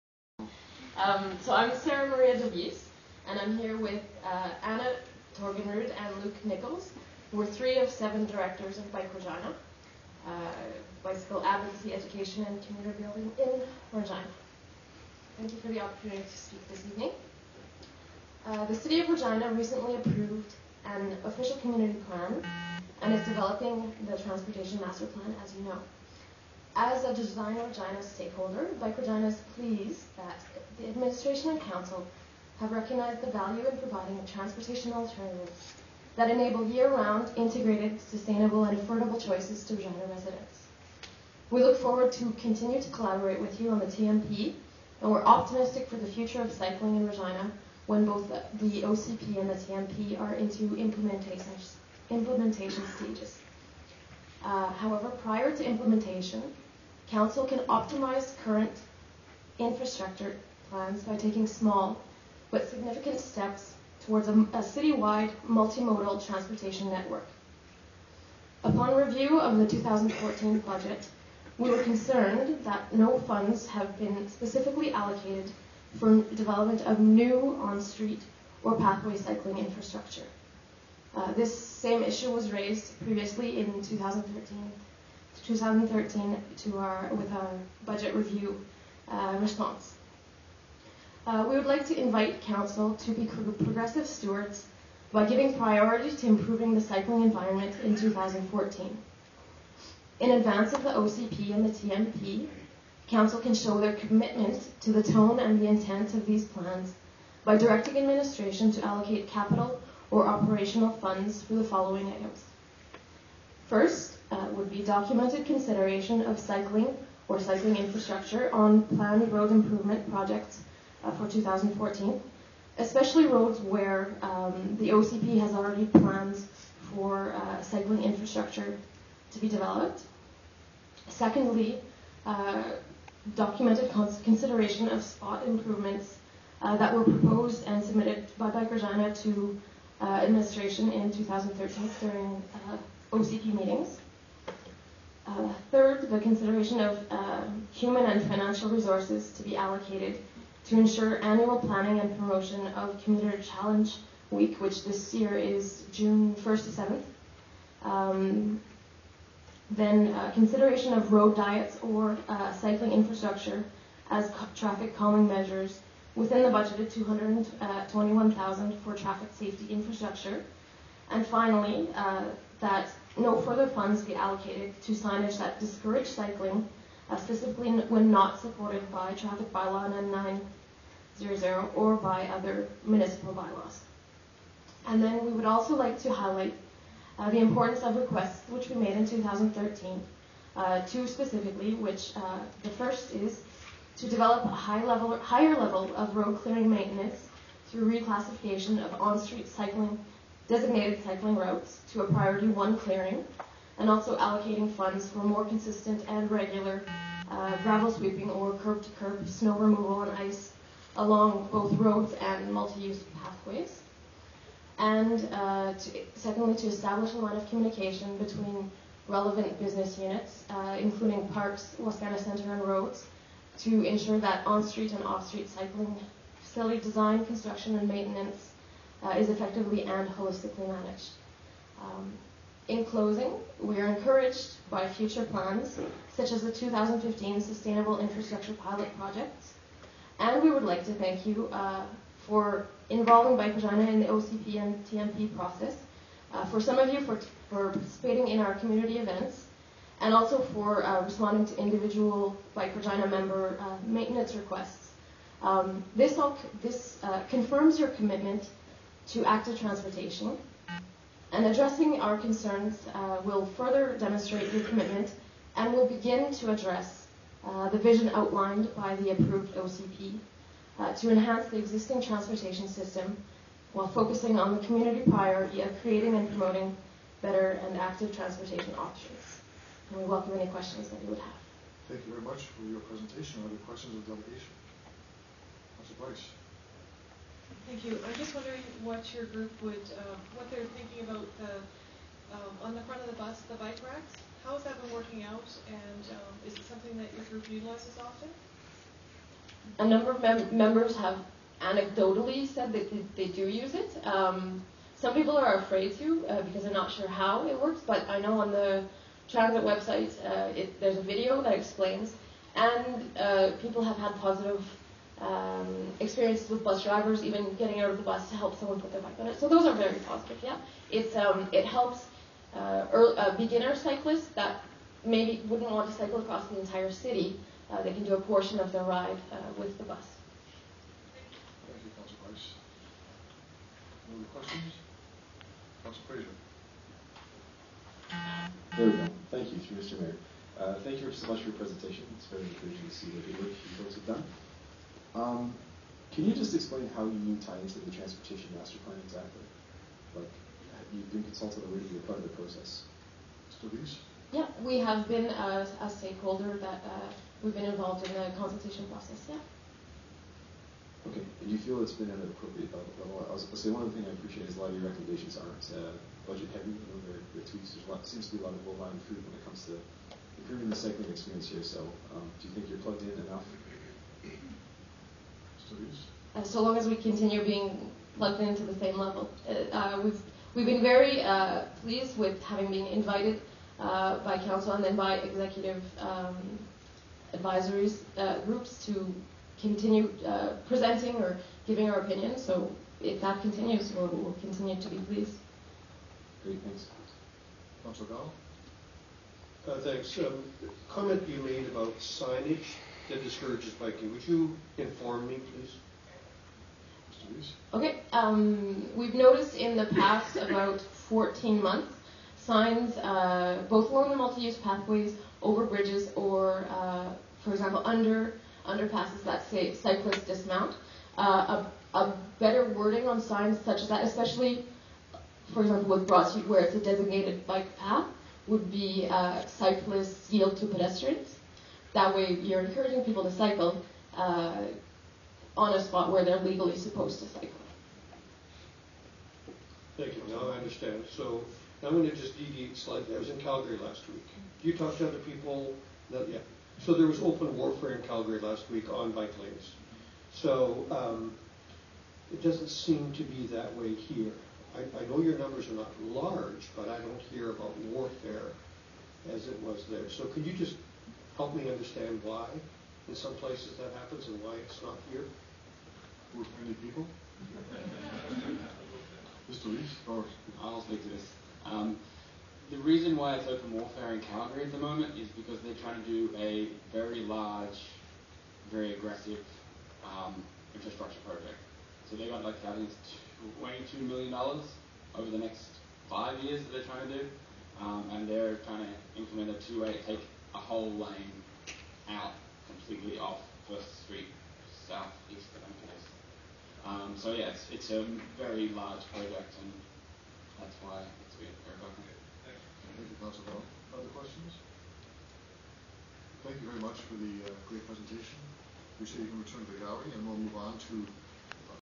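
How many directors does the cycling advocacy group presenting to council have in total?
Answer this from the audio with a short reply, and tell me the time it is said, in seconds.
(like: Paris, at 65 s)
7, at 7 s.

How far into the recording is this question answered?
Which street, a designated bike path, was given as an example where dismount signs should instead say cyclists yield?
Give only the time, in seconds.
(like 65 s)
426 s.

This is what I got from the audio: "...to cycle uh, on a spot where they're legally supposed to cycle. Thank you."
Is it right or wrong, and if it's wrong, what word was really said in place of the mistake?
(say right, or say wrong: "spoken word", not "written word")
right.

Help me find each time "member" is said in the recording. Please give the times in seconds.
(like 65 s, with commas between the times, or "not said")
253 s, 300 s.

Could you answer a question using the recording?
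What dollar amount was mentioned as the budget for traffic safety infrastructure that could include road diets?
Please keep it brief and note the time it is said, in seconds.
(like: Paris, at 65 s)
221,000, at 166 s.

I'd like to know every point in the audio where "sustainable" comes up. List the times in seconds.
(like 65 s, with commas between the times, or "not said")
38 s, 237 s.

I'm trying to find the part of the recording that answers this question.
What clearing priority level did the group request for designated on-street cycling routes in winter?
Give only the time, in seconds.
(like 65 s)
202 s.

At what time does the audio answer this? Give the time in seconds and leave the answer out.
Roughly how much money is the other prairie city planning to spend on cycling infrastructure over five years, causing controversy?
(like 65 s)
483 s.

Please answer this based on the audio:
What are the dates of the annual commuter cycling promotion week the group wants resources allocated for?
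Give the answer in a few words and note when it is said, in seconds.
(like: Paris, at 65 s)
June 1st to 7th, at 155 s.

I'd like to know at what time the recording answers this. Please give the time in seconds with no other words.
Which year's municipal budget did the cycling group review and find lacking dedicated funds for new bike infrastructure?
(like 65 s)
69 s.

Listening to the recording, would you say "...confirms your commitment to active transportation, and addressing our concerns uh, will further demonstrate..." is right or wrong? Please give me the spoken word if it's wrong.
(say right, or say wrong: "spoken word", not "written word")
right.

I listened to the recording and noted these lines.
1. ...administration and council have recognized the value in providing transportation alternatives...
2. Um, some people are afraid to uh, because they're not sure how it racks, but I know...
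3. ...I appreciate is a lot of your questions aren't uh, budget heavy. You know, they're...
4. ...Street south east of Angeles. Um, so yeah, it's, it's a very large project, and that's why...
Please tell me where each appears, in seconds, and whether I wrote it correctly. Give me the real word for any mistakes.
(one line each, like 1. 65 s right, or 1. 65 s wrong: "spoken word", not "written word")
1. 30 s right
2. 304 s wrong: "works", not "racks"
3. 364 s wrong: "recommendations", not "questions"
4. 494 s right.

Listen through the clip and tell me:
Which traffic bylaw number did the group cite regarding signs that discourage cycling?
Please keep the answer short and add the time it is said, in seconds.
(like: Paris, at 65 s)
9900, at 179 s.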